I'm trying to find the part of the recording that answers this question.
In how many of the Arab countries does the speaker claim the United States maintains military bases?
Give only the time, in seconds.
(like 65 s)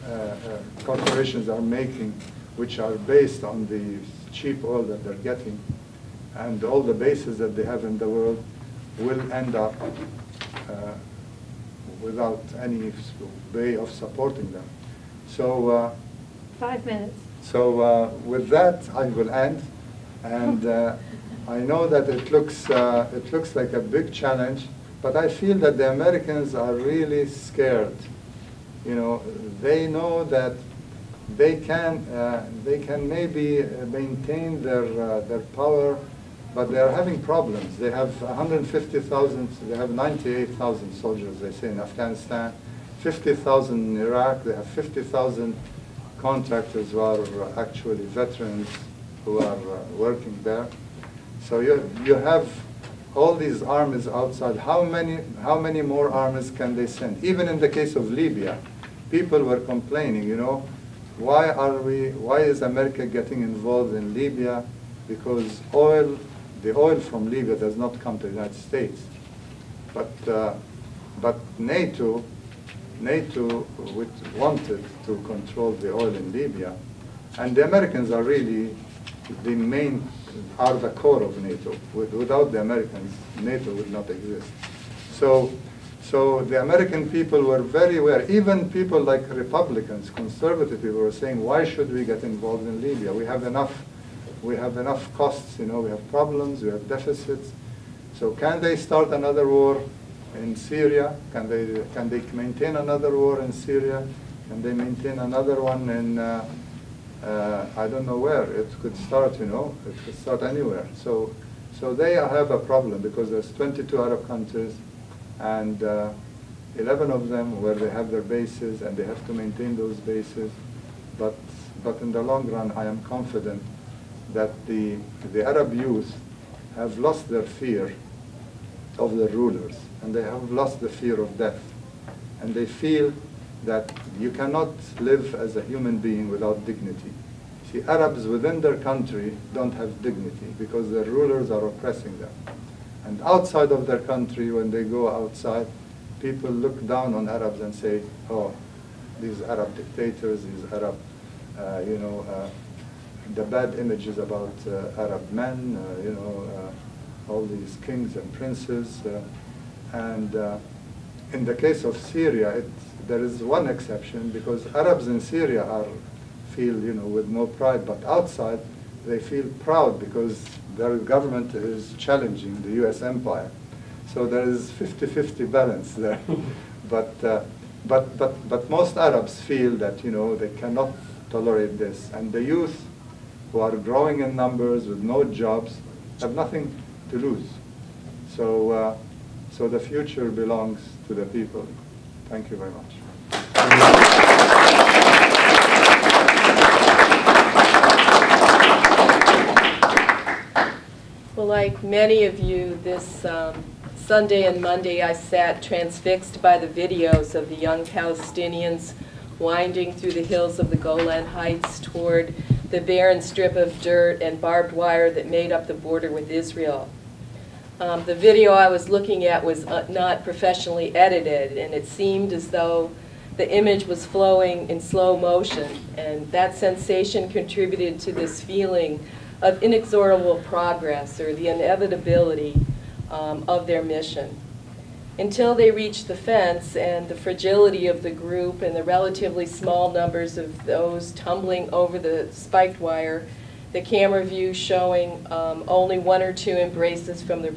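116 s.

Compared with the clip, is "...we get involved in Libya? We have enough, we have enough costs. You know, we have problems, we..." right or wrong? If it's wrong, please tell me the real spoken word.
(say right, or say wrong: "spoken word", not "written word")
right.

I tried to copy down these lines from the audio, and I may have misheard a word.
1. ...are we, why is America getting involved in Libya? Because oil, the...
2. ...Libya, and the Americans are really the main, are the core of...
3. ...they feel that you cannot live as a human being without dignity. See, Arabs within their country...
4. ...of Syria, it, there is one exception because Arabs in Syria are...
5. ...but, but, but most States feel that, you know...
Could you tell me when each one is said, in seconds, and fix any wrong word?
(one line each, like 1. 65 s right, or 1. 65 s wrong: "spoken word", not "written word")
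1. 61 s right
2. 76 s right
3. 132 s right
4. 161 s right
5. 177 s wrong: "Arabs", not "States".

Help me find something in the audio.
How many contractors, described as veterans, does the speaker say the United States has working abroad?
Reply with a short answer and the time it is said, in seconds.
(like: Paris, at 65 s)
50,000, at 44 s.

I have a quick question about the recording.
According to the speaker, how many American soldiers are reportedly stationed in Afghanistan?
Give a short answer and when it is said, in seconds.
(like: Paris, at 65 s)
98,000, at 39 s.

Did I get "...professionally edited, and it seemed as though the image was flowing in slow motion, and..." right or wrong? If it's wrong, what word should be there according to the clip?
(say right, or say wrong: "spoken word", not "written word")
right.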